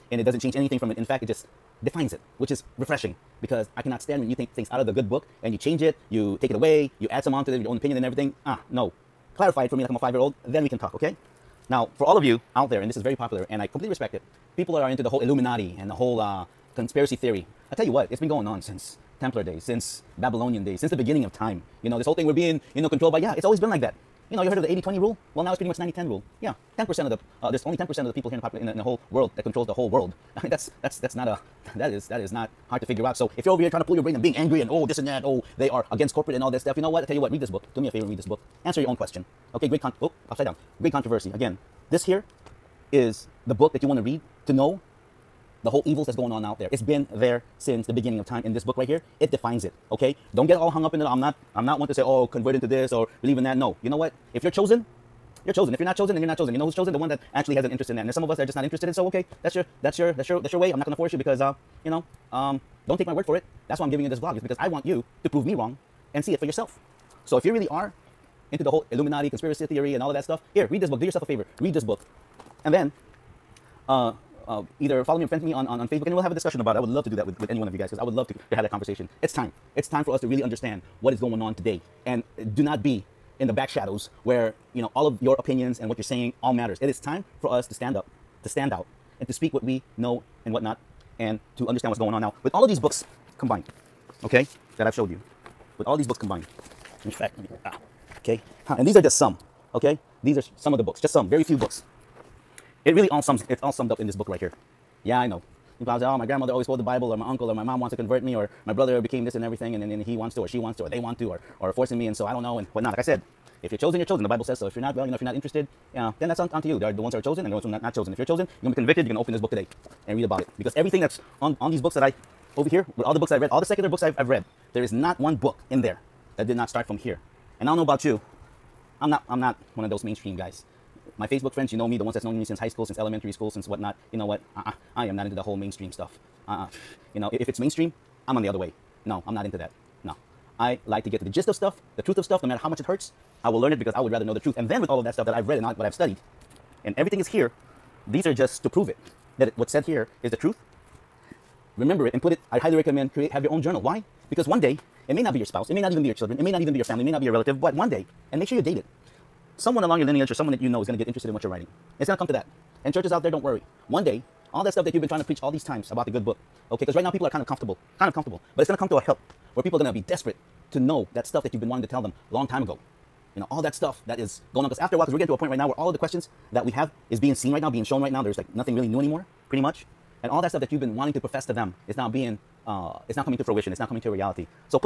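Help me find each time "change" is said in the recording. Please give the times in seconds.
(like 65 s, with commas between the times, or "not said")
0 s, 5 s.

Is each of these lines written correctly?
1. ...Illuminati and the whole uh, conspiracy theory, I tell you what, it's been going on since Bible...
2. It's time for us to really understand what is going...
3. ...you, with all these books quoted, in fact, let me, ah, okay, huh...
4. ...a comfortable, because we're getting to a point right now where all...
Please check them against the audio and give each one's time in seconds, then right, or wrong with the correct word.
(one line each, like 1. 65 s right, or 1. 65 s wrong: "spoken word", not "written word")
1. 15 s wrong: "Templar", not "Bible"
2. 79 s right
3. 95 s wrong: "combined", not "quoted"
4. 174 s wrong: "while", not "comfortable".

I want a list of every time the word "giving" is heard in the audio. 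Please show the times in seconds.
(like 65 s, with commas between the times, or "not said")
63 s.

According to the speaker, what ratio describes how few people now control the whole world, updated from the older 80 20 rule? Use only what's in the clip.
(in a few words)
90 10.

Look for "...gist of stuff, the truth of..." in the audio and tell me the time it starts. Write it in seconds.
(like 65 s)
141 s.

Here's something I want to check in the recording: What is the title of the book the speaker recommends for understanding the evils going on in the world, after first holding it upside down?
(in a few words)
Great Controversy.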